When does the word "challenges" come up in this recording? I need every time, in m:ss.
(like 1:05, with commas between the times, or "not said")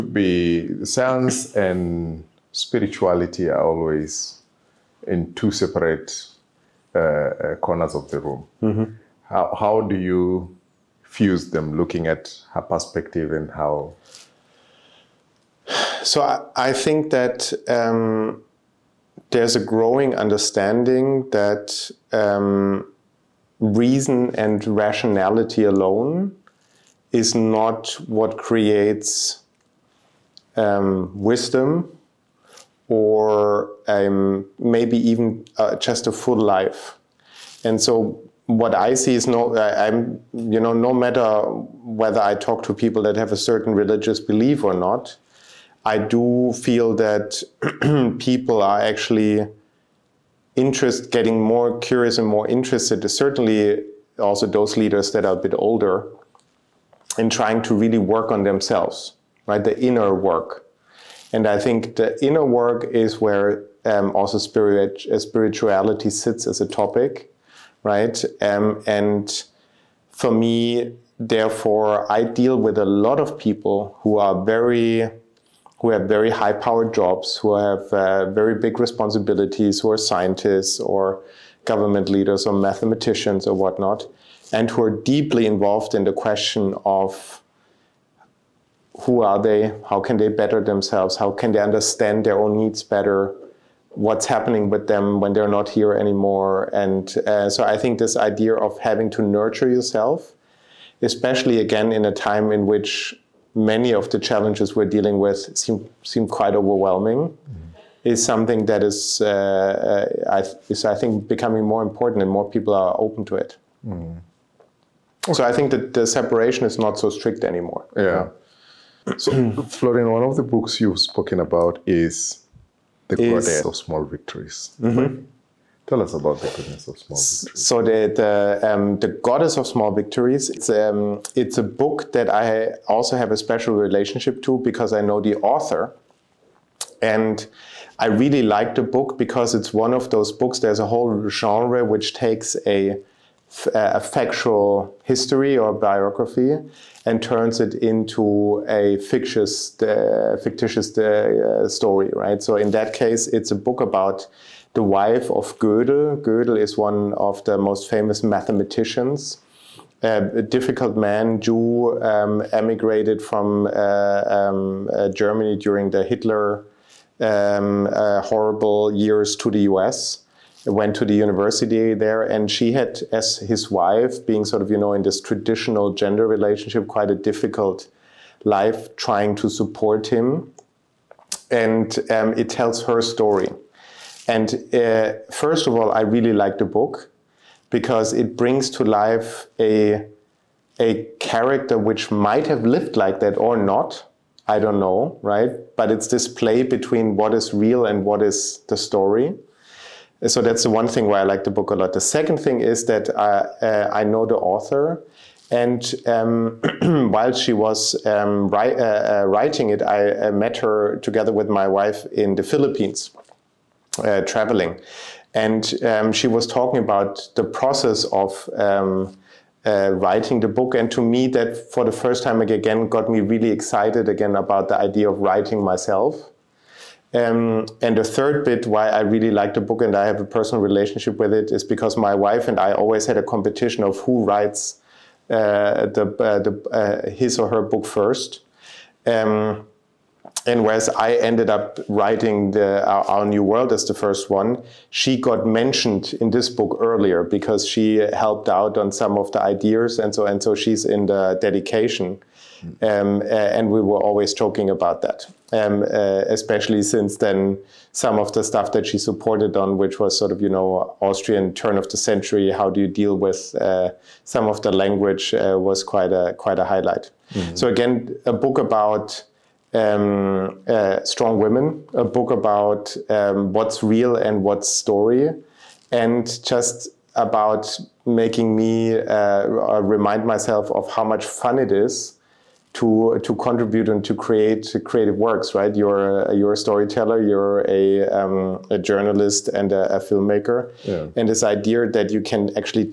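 1:44.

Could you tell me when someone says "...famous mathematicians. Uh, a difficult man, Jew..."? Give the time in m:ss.
2:37.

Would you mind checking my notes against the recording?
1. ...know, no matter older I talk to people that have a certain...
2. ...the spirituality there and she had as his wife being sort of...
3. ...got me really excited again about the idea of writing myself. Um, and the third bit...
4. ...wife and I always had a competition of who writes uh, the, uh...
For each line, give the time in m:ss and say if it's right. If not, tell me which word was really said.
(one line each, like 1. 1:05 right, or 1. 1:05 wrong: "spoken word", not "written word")
1. 0:40 wrong: "whether", not "older"
2. 2:51 wrong: "university", not "spirituality"
3. 3:42 right
4. 3:52 right.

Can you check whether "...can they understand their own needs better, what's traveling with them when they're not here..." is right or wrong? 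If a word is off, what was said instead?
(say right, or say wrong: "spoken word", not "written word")
wrong: "happening", not "traveling".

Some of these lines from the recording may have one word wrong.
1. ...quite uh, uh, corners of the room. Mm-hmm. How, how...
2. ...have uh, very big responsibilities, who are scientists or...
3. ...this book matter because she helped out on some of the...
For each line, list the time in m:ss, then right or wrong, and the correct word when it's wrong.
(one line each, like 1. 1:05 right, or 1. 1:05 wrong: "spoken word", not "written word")
1. 0:05 wrong: "separate", not "quite"
2. 1:17 right
3. 4:06 wrong: "earlier", not "matter".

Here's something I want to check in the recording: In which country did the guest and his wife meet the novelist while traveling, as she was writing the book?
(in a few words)
Philippines.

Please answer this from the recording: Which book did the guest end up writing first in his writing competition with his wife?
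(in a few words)
Our New World.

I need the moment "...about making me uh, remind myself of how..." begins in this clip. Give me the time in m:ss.
4:37.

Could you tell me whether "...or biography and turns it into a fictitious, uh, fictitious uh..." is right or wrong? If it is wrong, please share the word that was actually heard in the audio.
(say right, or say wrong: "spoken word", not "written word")
right.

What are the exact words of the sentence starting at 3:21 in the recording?
The second thing is that I, uh, uh, I know the author.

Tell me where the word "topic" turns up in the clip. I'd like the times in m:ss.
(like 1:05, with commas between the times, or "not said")
1:06.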